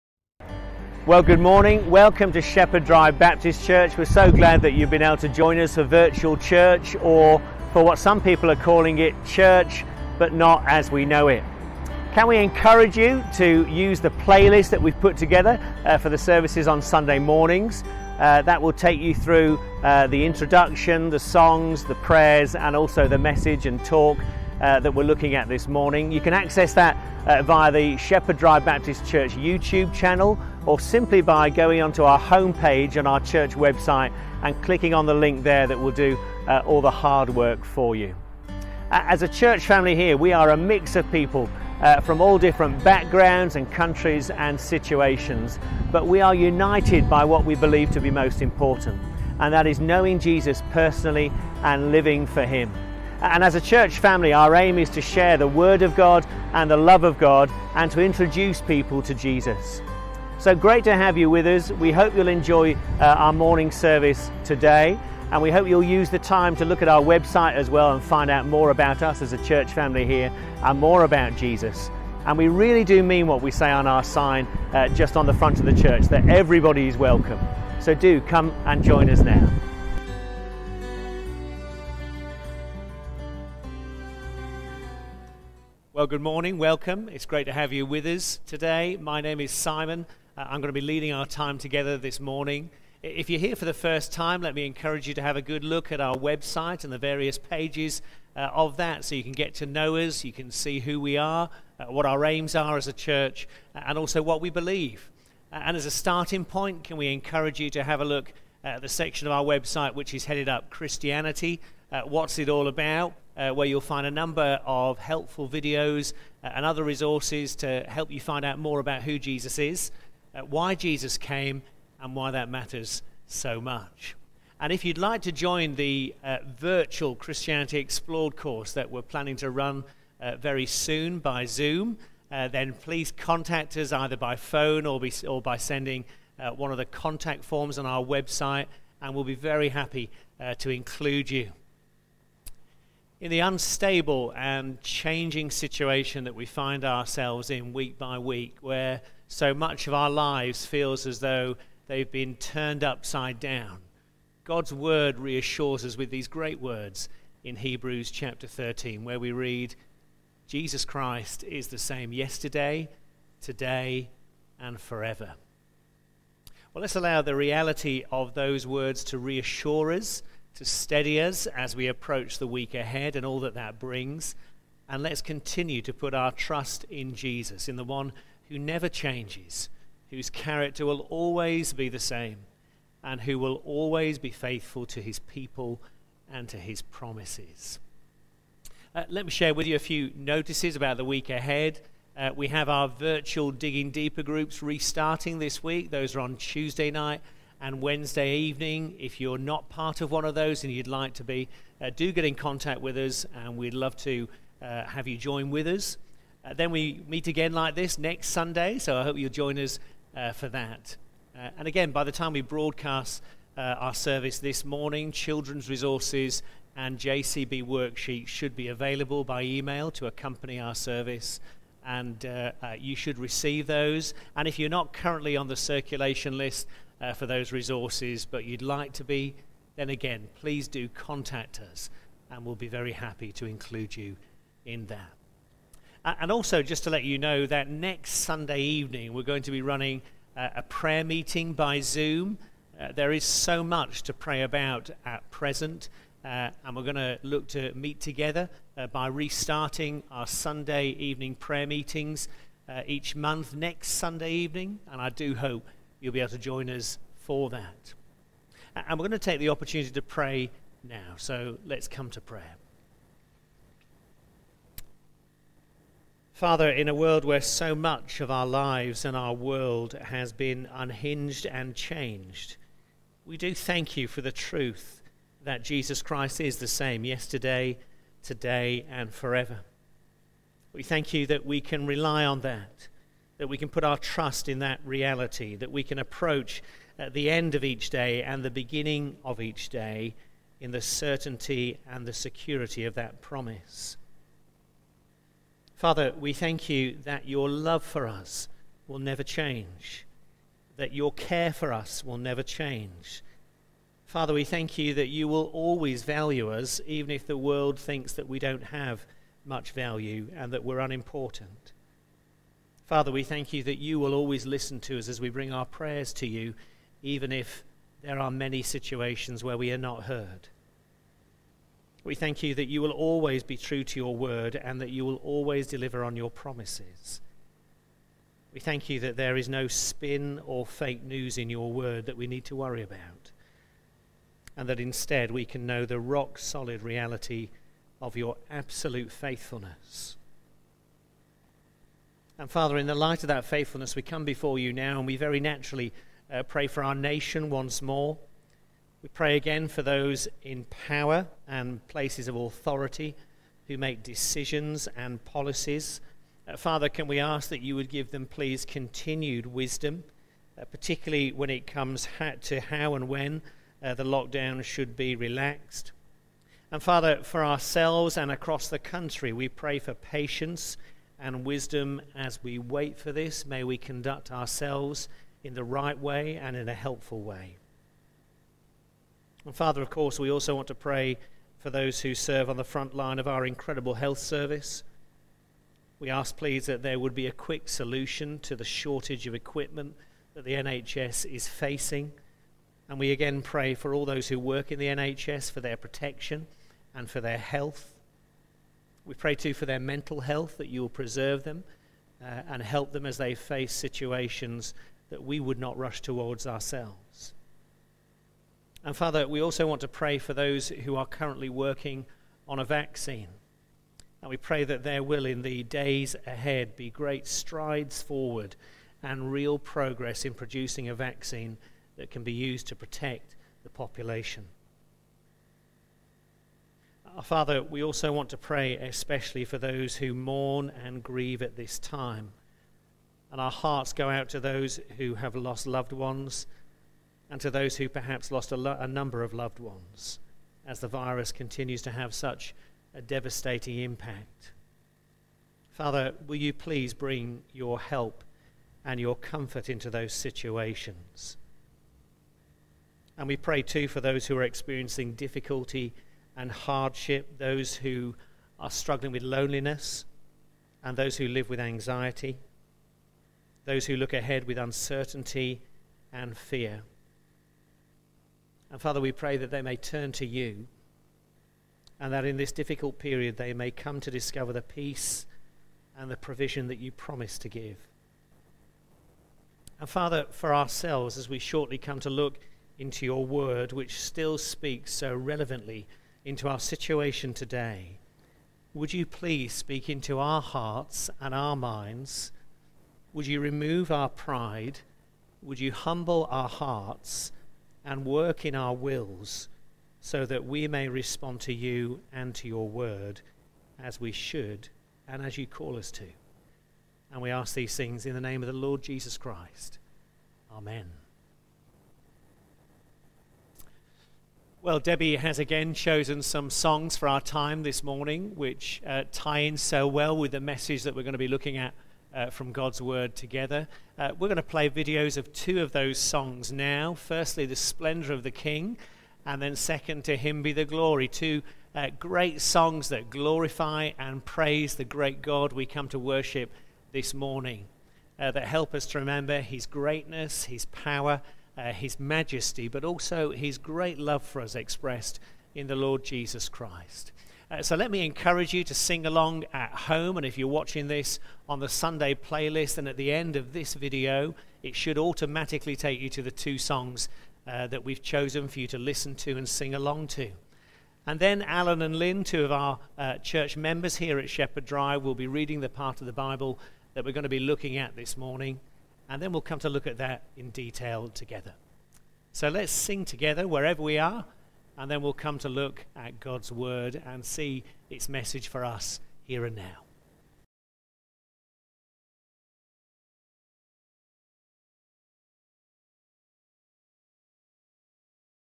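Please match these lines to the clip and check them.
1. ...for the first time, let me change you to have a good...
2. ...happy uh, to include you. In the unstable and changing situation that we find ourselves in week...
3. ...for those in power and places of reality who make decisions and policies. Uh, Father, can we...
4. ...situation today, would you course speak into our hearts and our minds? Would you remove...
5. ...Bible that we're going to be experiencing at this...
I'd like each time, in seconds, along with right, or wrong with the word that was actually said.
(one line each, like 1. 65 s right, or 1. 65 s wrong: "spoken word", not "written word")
1. 93 s wrong: "encourage", not "change"
2. 139 s right
3. 349 s wrong: "authority", not "reality"
4. 486 s wrong: "please", not "course"
5. 566 s wrong: "looking", not "experiencing".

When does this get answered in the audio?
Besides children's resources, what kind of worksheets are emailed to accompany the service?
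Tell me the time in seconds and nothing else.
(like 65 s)
216 s.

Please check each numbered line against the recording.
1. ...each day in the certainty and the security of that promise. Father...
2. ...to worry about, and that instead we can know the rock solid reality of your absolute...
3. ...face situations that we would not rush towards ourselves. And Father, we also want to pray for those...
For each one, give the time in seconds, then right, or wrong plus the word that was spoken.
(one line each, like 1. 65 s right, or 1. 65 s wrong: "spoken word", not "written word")
1. 289 s right
2. 332 s right
3. 403 s right.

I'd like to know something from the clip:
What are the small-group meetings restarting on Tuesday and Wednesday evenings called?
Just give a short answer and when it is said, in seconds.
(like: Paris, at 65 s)
Digging Deeper, at 193 s.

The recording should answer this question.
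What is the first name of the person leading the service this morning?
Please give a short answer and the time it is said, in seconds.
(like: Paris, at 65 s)
Simon, at 89 s.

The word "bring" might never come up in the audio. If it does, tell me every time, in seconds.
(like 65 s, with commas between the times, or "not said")
173 s, 315 s, 446 s.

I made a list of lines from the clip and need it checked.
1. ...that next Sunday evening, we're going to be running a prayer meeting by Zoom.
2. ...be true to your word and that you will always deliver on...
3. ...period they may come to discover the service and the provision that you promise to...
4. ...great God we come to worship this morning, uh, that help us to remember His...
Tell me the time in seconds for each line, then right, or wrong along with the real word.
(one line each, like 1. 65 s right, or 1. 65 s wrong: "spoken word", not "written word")
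1. 237 s right
2. 323 s right
3. 472 s wrong: "peace", not "service"
4. 534 s right.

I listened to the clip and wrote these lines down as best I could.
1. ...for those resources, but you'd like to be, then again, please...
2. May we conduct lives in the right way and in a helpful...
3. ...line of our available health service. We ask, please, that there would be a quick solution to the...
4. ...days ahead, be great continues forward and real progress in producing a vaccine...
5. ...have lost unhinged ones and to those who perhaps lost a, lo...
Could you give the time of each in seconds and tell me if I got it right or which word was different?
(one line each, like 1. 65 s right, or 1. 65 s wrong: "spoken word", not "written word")
1. 227 s right
2. 373 s wrong: "ourselves", not "lives"
3. 382 s wrong: "incredible", not "available"
4. 415 s wrong: "strides", not "continues"
5. 435 s wrong: "loved", not "unhinged".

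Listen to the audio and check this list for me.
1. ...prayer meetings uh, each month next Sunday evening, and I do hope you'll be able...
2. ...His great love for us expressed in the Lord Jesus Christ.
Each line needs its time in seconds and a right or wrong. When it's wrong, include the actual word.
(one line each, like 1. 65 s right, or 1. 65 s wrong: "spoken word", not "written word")
1. 251 s right
2. 543 s right.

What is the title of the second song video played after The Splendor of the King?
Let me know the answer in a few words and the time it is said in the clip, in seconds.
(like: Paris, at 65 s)
To Him Be the Glory, at 530 s.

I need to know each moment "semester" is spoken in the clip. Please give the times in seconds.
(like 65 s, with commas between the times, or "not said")
not said.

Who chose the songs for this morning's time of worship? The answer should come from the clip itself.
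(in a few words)
Debbie.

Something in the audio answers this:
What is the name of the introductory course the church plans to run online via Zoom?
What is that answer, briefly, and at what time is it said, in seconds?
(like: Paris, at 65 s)
Christianity Explored, at 127 s.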